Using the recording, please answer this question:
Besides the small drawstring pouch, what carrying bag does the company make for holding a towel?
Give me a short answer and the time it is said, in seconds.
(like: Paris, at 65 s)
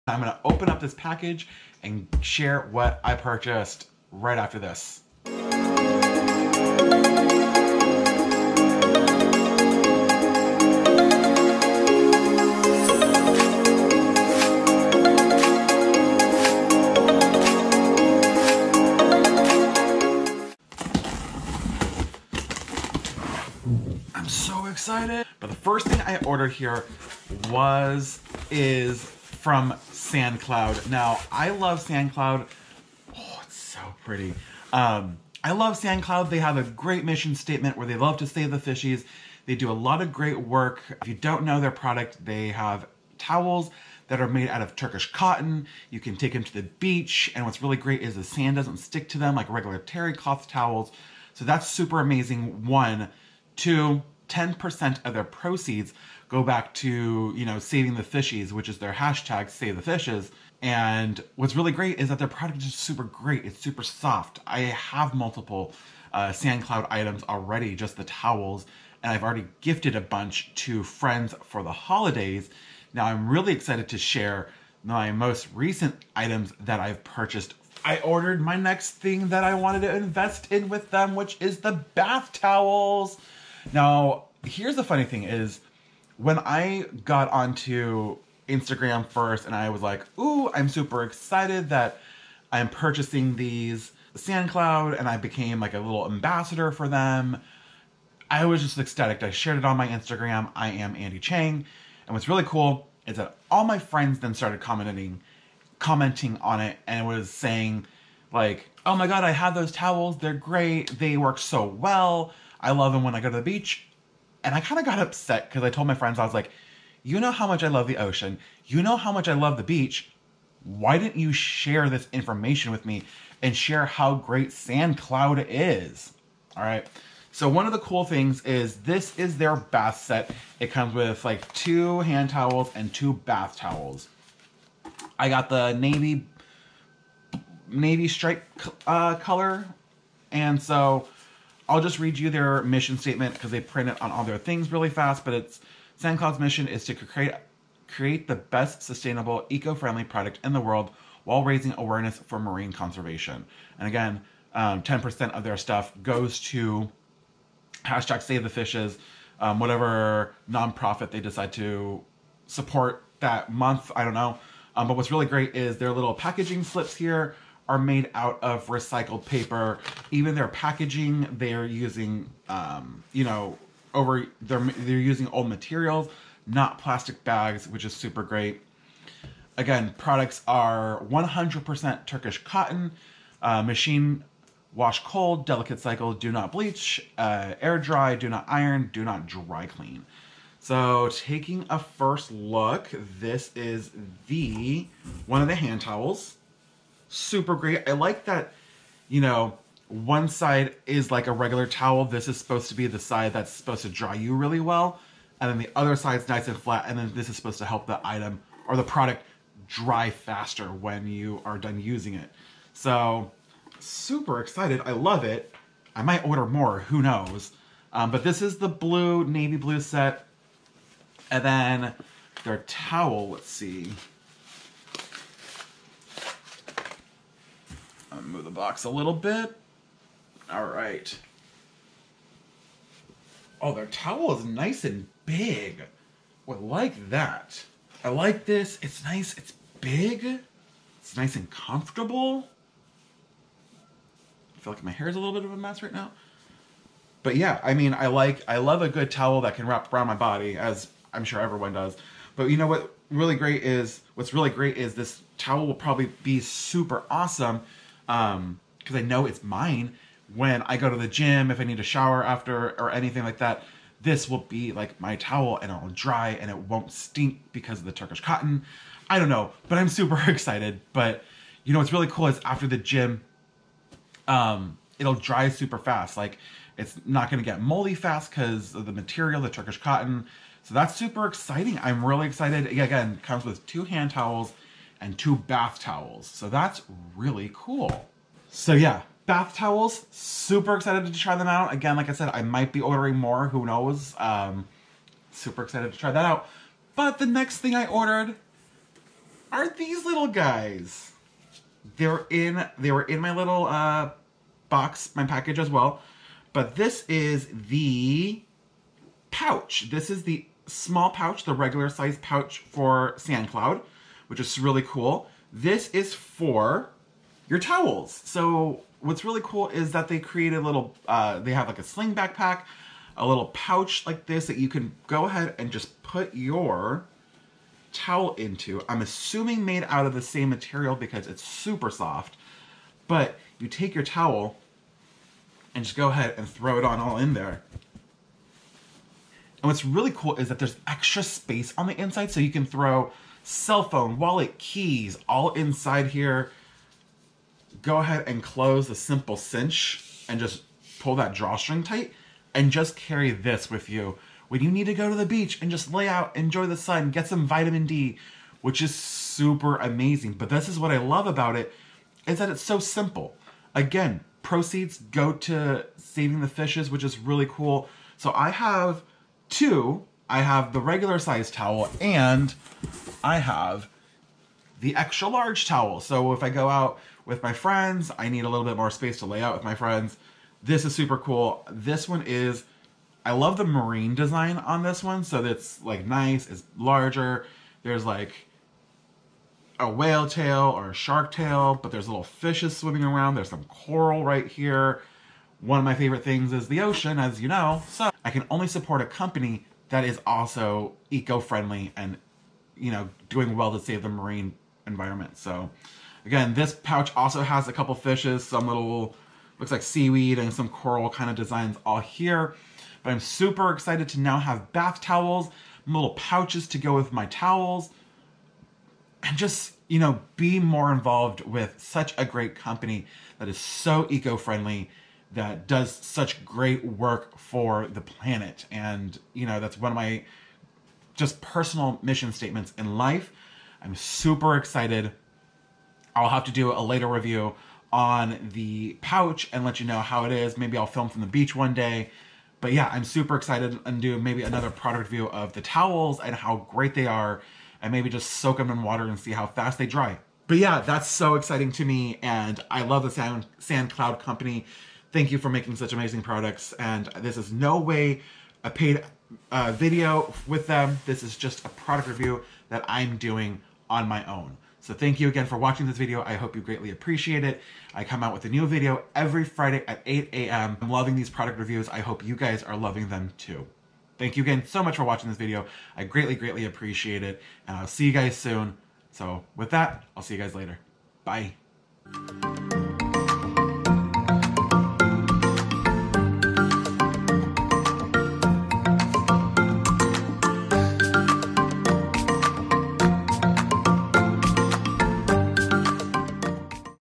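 Sling backpack, at 321 s.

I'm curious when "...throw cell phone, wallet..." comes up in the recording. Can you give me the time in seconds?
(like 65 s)
342 s.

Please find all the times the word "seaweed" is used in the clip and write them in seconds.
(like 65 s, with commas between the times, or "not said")
409 s.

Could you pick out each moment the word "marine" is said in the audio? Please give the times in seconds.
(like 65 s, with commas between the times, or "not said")
152 s, 383 s, 404 s.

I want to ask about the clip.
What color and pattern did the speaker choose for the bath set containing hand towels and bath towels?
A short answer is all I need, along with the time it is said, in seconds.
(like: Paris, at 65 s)
Navy stripe, at 135 s.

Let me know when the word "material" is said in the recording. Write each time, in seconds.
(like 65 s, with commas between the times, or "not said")
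175 s, 278 s, 330 s.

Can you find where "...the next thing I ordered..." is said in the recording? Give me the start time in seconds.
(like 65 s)
297 s.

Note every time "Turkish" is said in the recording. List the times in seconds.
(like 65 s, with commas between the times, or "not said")
44 s, 182 s, 267 s, 279 s.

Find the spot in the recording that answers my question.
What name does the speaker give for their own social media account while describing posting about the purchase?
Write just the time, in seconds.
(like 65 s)
100 s.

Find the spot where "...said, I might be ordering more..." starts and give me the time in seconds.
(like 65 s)
292 s.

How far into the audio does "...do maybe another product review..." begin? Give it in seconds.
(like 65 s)
444 s.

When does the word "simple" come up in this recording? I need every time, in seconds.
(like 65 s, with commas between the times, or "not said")
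348 s, 362 s.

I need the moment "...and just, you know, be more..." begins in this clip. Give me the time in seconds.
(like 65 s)
419 s.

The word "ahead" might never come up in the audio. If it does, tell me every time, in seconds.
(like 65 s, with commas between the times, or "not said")
325 s, 336 s, 347 s.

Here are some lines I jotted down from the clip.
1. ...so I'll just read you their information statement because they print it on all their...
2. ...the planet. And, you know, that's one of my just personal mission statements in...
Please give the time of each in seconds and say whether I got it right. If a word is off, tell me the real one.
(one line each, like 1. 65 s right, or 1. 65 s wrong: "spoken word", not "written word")
1. 140 s wrong: "mission", not "information"
2. 427 s right.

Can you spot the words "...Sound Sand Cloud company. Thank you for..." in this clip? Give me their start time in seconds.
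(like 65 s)
453 s.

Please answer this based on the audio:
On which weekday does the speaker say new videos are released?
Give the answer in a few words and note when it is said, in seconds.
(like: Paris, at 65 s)
Friday, at 469 s.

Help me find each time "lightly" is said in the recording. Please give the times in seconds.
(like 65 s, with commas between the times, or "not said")
not said.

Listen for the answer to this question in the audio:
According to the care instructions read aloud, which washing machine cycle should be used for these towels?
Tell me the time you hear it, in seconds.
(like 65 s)
185 s.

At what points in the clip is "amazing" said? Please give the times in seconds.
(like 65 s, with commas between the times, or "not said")
52 s, 359 s, 455 s.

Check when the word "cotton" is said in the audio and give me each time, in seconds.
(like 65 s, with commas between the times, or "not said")
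45 s, 182 s, 268 s, 279 s.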